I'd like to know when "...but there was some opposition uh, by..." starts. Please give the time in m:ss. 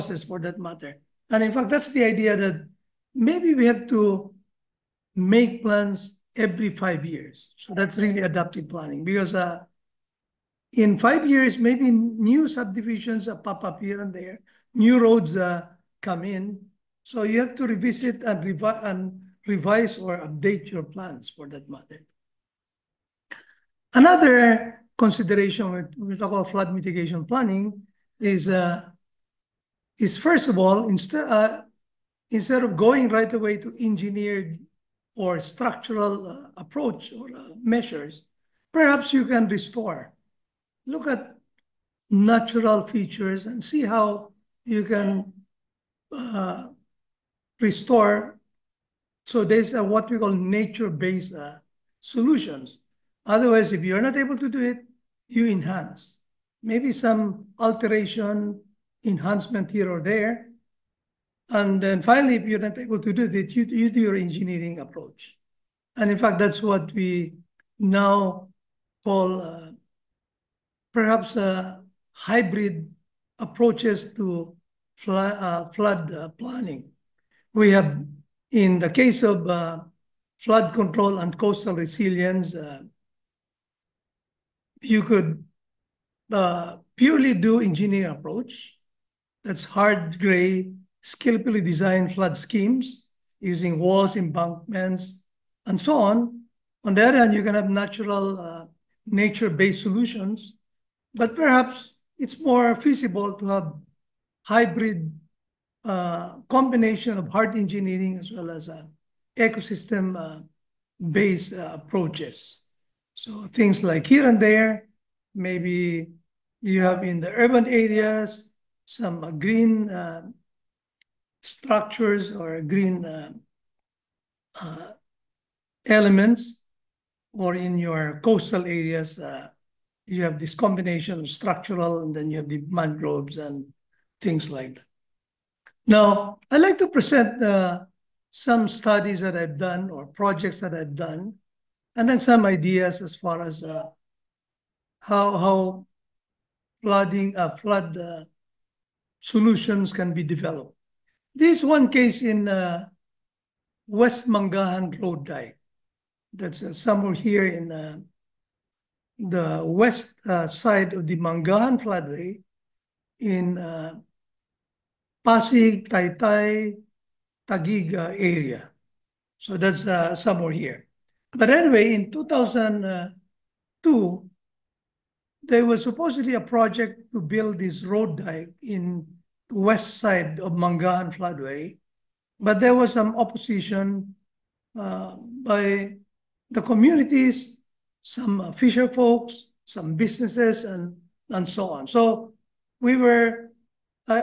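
3:02.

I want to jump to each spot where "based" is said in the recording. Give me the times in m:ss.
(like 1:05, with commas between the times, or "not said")
0:50, 1:39, 1:49.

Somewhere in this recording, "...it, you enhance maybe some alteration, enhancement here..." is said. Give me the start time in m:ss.
0:54.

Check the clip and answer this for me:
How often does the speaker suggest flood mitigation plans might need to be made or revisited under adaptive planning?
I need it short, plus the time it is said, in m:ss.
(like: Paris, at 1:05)
every 5 years, at 0:06.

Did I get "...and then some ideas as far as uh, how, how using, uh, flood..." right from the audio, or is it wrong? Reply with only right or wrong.
wrong.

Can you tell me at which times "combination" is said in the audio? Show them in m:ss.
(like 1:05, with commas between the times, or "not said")
1:46, 2:10.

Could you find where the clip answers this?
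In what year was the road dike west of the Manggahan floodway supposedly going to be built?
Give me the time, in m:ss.
2:52.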